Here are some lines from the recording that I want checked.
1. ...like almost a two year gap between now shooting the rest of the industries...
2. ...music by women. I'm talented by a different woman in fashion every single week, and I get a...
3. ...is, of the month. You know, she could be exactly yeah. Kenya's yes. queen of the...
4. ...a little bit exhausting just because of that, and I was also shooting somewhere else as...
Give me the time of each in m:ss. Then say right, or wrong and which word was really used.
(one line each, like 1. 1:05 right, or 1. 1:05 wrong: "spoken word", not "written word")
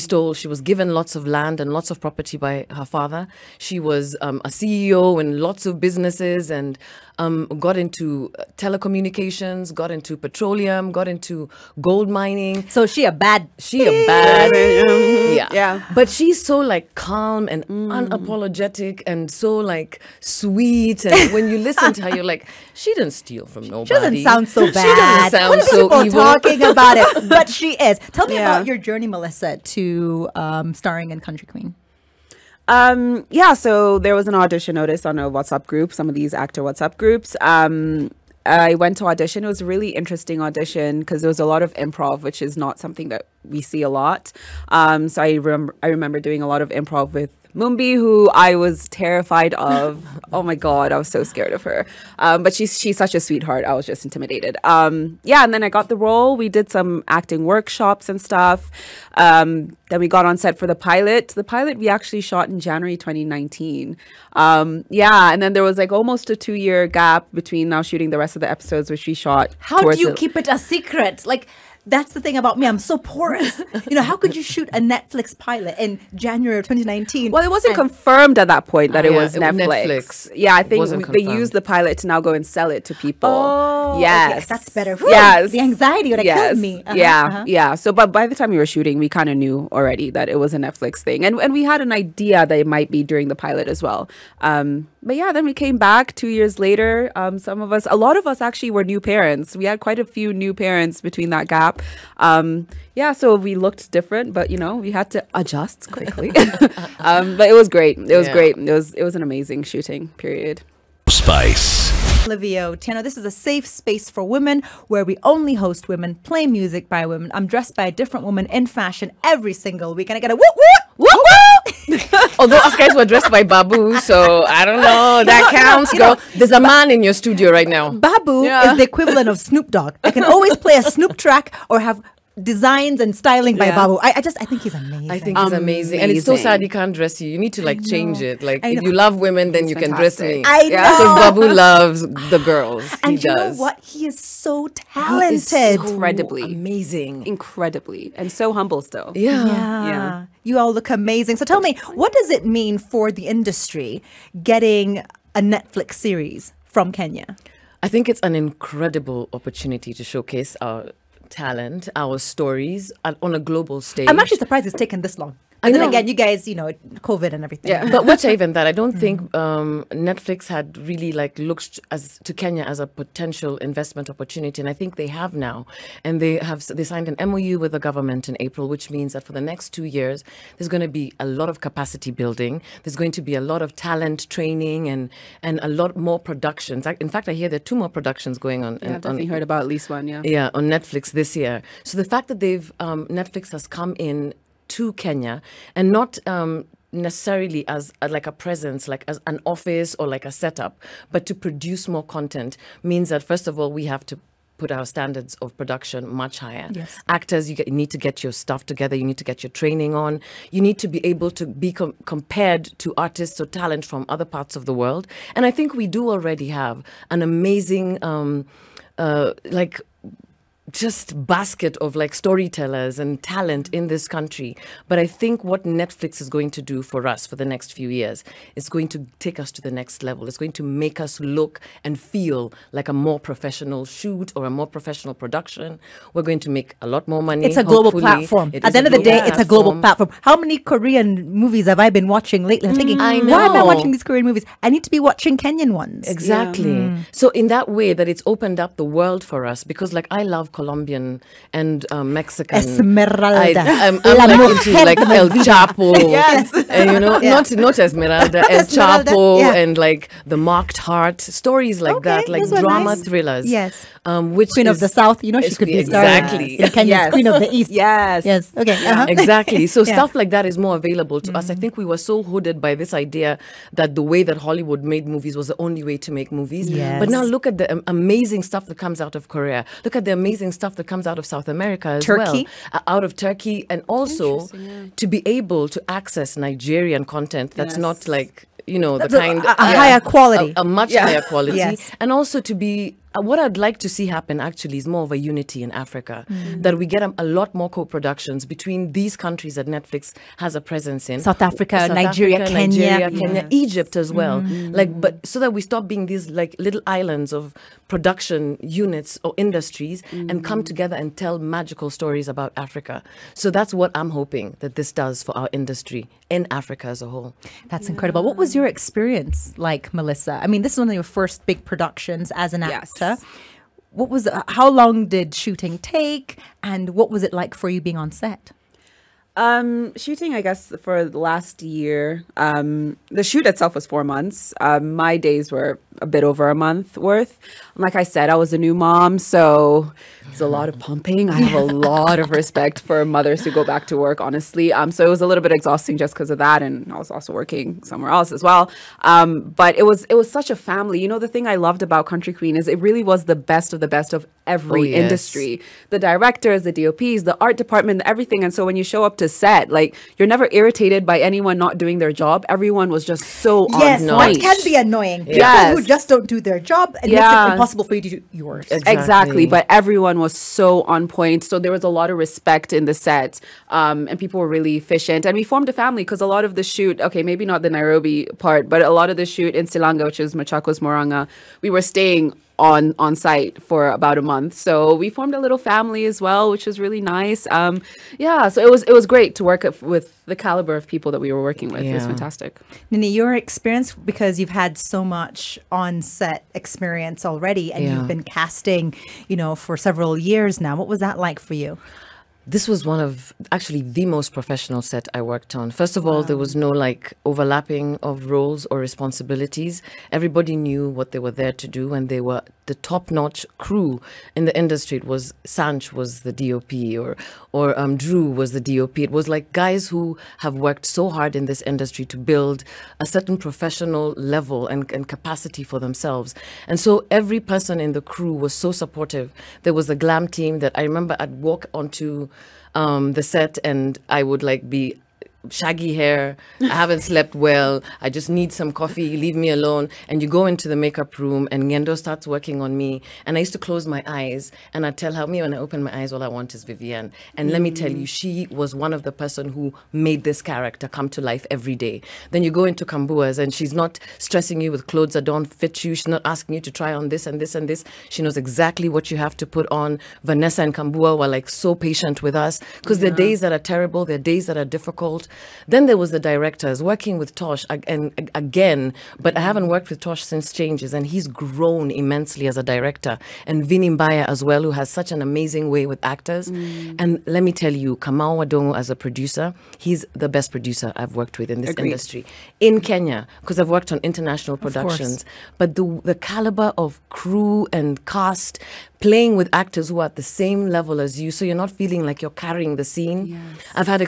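1. 1:05 wrong: "episodes", not "industries"
2. 1:56 wrong: "dressed", not "talented"
3. 4:24 wrong: "south", not "month"
4. 5:45 wrong: "working", not "shooting".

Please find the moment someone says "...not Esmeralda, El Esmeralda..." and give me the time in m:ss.
4:17.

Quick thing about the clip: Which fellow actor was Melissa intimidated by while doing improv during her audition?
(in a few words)
Mumbi.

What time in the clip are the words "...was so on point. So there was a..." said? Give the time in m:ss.
6:10.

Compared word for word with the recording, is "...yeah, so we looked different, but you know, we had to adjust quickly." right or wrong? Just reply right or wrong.
right.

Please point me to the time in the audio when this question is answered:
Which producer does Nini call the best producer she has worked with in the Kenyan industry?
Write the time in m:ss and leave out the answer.
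7:57.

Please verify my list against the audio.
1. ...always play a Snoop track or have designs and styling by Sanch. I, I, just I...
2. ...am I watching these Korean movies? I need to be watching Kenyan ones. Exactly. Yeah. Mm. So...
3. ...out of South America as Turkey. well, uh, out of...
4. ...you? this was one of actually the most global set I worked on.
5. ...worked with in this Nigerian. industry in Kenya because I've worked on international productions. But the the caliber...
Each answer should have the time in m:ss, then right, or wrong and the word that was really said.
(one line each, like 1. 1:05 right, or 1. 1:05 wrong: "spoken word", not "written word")
1. 2:10 wrong: "Babu", not "Sanch"
2. 4:03 right
3. 4:41 right
4. 6:41 wrong: "professional", not "global"
5. 8:01 wrong: "Agreed", not "Nigerian".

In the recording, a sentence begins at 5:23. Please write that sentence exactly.
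What was uh, how long did shooting take, and what was it like for you being on set?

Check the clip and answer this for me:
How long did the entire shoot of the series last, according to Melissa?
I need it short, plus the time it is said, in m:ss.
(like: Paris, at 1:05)
Four months, at 5:33.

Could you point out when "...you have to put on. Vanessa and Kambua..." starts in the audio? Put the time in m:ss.
7:39.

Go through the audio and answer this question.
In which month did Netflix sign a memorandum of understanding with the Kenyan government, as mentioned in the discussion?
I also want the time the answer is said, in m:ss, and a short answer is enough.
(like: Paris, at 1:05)
April, at 2:58.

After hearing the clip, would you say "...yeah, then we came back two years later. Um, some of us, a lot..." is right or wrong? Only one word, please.
right.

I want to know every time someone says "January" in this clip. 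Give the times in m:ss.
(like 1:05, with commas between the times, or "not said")
1:02, 1:16.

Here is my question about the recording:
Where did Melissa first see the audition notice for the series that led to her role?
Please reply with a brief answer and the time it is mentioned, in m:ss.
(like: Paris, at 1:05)
WhatsApp group, at 0:35.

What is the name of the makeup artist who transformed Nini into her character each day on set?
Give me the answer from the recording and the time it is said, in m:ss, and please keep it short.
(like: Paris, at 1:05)
Ngendo, at 7:21.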